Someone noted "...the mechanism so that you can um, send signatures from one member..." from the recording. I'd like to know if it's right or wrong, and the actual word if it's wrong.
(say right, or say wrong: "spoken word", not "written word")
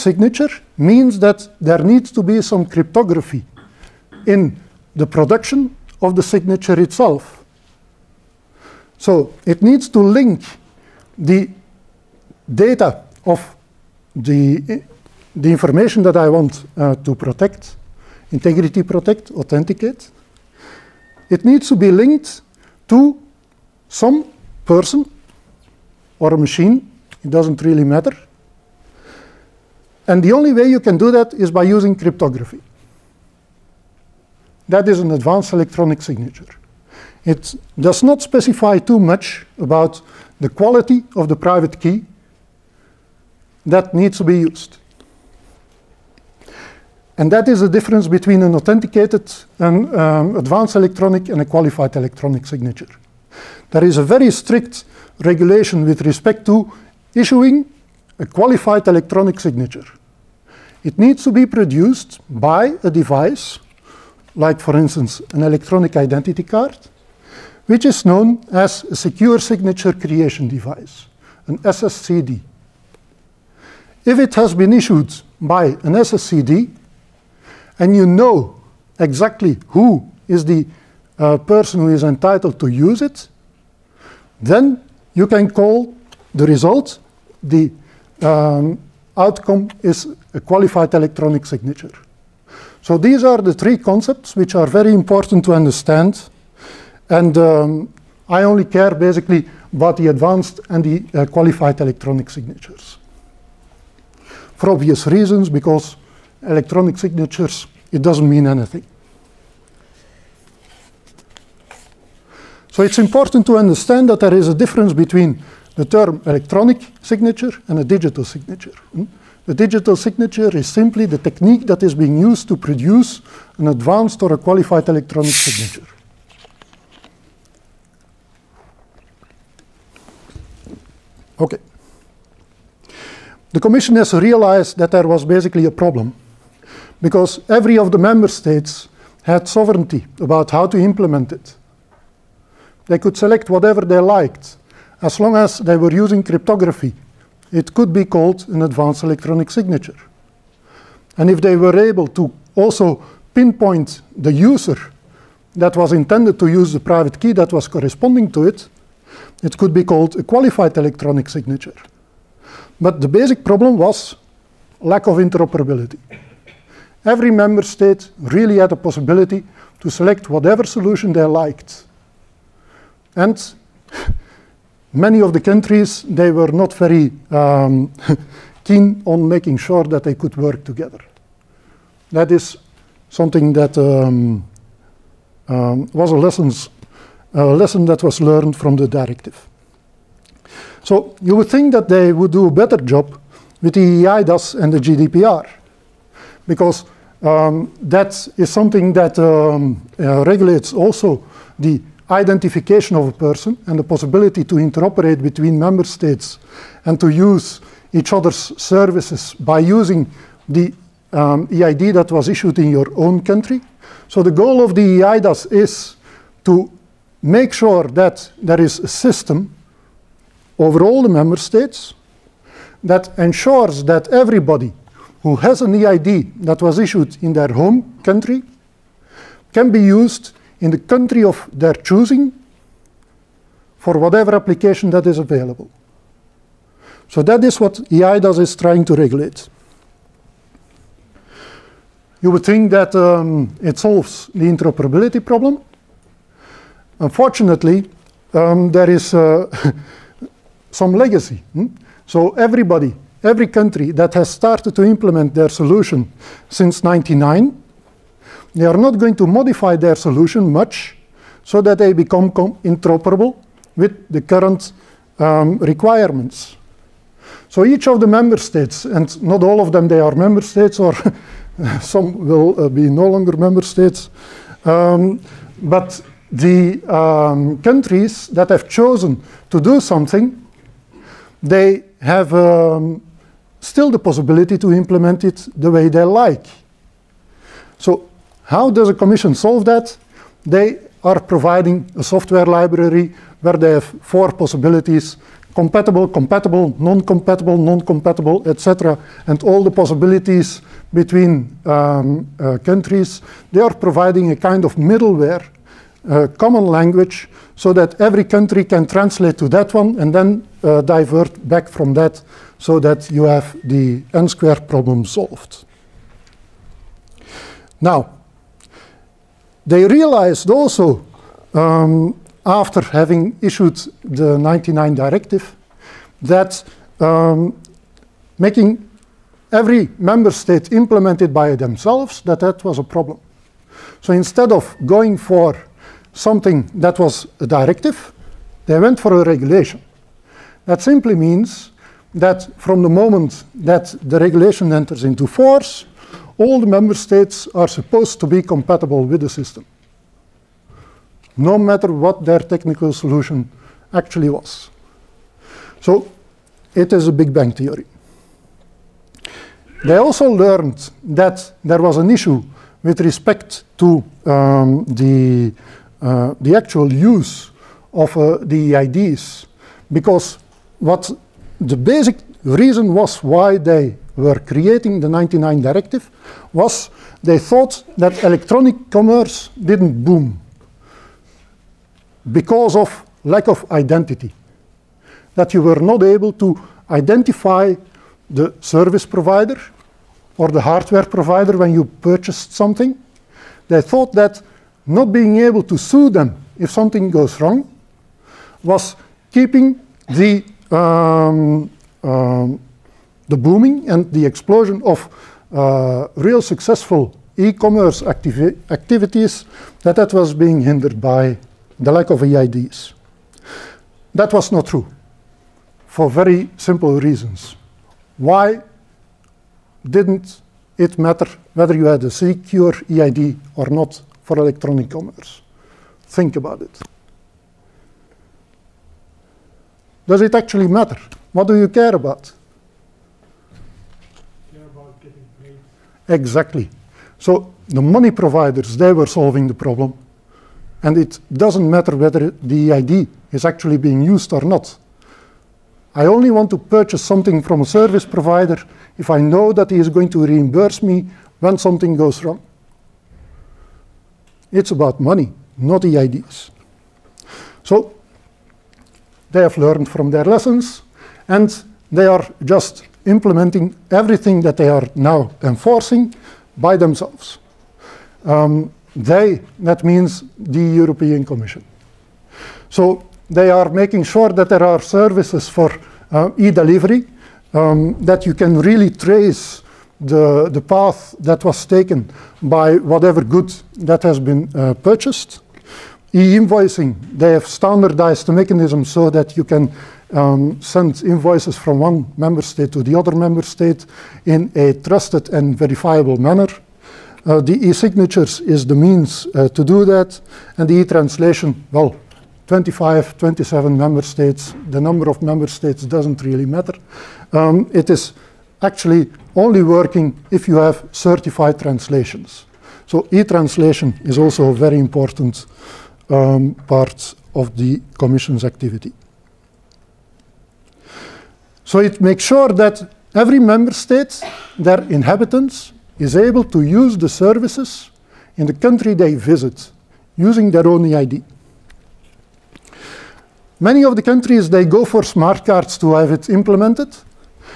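wrong: "invoices", not "signatures".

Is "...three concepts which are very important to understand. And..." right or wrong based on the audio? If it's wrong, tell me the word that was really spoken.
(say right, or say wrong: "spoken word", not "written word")
right.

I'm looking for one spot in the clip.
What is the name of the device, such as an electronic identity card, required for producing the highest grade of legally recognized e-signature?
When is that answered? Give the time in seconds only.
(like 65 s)
68 s.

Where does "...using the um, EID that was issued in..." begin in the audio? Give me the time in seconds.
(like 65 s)
209 s.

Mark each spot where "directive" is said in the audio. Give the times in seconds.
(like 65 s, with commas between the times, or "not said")
188 s, 324 s, 337 s, 375 s.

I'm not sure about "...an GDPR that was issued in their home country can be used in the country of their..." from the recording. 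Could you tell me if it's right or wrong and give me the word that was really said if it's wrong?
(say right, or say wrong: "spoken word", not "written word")
wrong: "EID", not "GDPR".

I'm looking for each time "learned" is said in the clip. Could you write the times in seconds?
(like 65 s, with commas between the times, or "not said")
188 s, 360 s, 459 s.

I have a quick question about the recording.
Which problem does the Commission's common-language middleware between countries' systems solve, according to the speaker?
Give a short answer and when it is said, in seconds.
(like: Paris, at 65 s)
n-square problem, at 314 s.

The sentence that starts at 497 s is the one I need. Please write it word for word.
Uh, the e-signatures is the means uh, to do that.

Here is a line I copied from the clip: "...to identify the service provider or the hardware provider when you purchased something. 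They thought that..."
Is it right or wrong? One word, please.
right.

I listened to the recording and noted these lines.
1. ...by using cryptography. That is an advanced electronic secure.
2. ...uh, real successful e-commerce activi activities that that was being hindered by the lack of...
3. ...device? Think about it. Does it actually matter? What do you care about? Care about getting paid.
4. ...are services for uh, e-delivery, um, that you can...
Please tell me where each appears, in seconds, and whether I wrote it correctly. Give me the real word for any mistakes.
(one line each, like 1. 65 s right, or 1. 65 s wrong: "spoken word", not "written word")
1. 31 s wrong: "signature", not "secure"
2. 405 s right
3. 424 s wrong: "commerce", not "device"
4. 474 s right.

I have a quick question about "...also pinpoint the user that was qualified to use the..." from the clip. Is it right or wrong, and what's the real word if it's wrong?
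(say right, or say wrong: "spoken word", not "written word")
wrong: "intended", not "qualified".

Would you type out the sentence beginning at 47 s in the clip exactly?
And that is the difference between an authenticated and um, advanced electronic and a qualified electronic signature.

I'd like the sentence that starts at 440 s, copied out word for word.
And it doesn't matter whether the EID is actually being used or not.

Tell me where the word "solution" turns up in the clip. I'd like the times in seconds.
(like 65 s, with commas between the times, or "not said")
170 s, 255 s, 259 s, 352 s.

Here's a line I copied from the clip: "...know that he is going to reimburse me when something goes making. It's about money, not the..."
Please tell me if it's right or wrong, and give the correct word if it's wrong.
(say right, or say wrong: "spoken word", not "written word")
wrong: "wrong", not "making".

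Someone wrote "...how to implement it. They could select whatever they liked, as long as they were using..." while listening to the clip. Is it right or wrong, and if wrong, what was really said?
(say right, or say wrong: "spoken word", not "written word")
right.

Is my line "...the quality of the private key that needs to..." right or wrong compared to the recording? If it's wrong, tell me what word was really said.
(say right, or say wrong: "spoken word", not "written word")
right.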